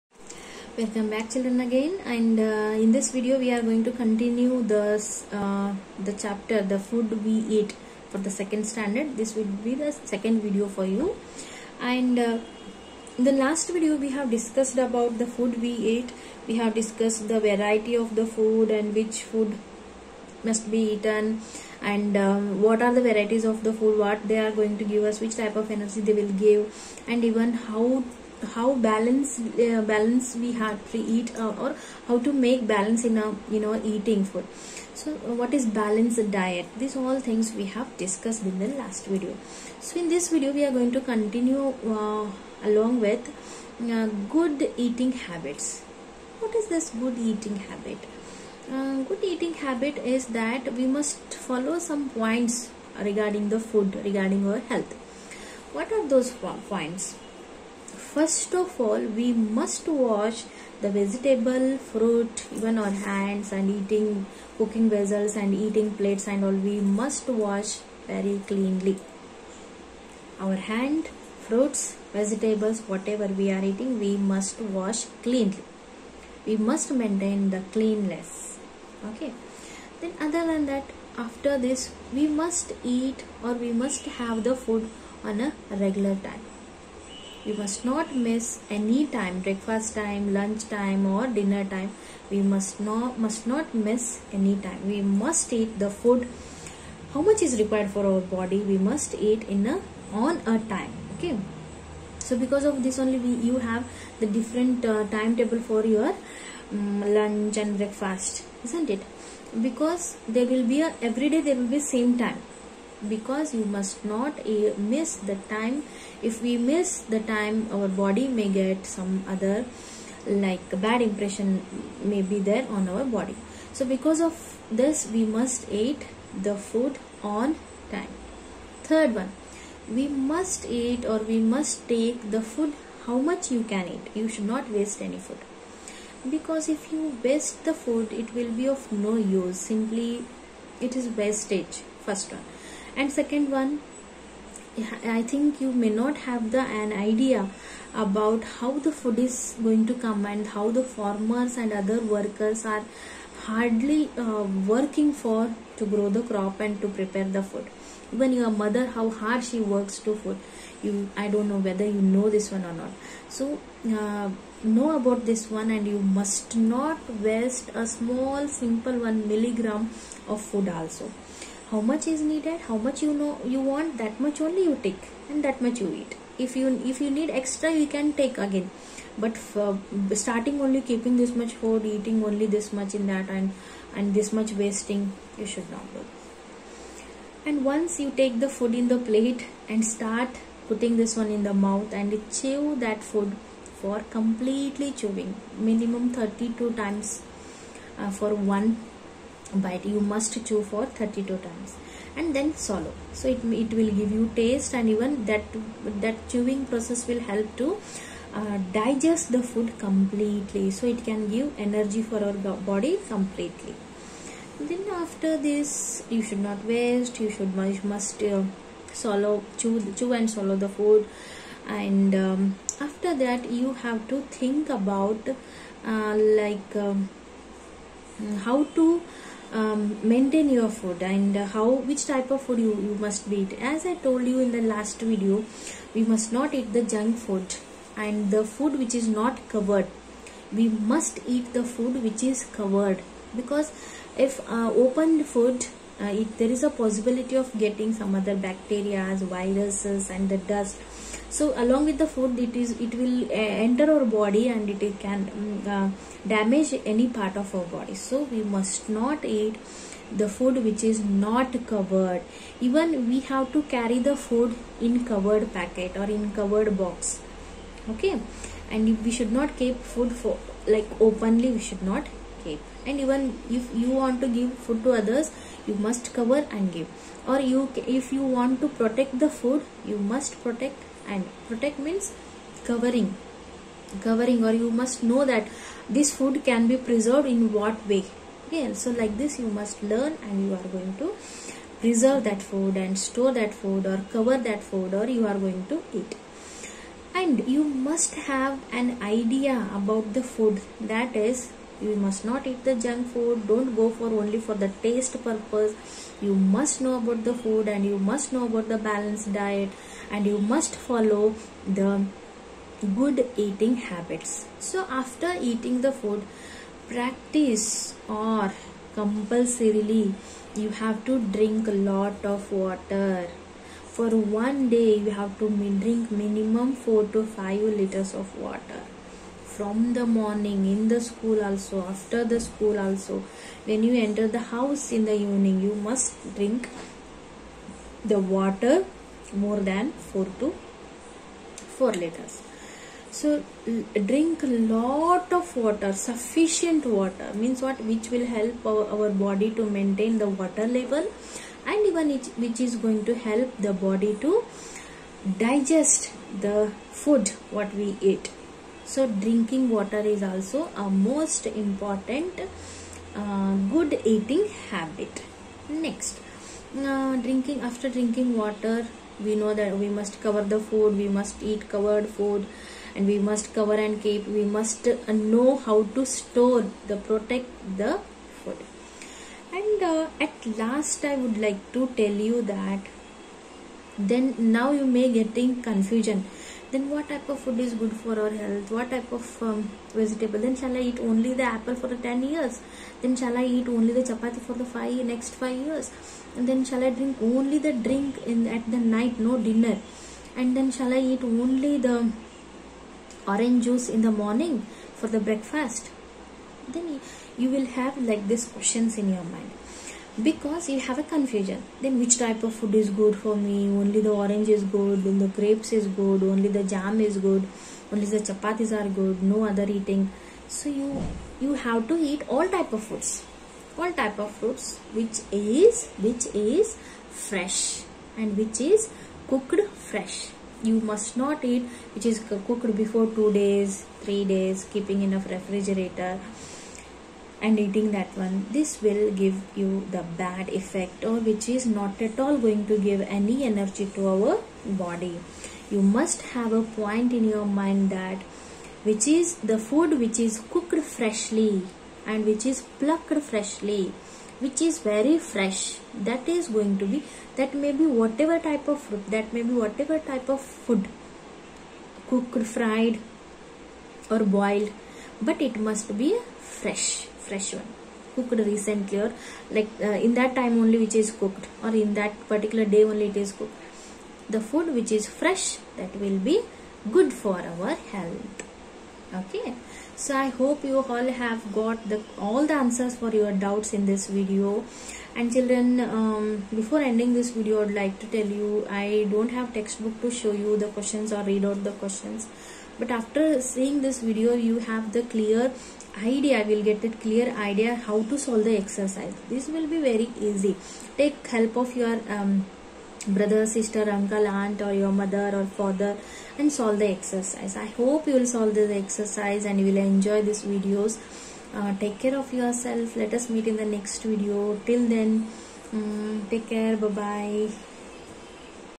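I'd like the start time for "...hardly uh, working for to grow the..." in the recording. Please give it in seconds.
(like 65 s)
153 s.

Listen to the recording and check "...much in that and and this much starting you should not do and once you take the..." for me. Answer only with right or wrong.
wrong.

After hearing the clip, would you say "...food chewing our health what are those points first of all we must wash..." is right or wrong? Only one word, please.
wrong.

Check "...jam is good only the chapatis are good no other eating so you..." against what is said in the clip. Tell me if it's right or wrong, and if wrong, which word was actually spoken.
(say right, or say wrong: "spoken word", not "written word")
right.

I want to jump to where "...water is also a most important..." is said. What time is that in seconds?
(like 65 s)
359 s.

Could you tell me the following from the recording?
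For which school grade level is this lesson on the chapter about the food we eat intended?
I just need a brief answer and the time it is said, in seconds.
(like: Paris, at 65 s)
Second standard, at 8 s.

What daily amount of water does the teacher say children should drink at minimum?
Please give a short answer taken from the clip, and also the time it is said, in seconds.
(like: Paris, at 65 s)
4 to 5 liters, at 326 s.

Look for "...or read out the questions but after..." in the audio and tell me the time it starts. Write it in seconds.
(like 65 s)
491 s.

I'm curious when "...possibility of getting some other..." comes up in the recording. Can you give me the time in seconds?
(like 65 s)
246 s.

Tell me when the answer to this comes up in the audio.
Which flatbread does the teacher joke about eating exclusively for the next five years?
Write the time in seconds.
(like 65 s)
394 s.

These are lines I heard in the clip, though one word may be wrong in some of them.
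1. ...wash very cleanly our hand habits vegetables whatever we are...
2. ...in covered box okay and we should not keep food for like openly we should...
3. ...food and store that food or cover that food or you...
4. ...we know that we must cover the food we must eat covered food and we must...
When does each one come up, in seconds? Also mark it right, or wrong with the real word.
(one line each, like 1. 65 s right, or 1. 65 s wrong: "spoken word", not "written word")
1. 67 s wrong: "fruits", not "habits"
2. 266 s right
3. 292 s right
4. 369 s right.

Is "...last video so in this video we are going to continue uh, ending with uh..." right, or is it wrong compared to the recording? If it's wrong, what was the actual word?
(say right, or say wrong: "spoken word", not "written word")
wrong: "along", not "ending".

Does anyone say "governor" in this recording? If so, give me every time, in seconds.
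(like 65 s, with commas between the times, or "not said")
not said.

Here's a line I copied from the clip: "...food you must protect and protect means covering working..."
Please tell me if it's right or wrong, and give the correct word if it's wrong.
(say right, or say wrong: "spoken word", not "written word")
wrong: "covering", not "working".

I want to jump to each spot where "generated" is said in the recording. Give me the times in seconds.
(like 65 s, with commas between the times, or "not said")
not said.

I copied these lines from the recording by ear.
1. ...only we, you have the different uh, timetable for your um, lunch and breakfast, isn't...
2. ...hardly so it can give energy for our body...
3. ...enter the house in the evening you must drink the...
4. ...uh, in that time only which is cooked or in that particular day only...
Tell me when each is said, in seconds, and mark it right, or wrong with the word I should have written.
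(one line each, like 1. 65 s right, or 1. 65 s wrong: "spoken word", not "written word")
1. 102 s right
2. 209 s wrong: "completely", not "hardly"
3. 334 s right
4. 469 s right.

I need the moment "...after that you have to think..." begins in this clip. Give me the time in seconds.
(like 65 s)
222 s.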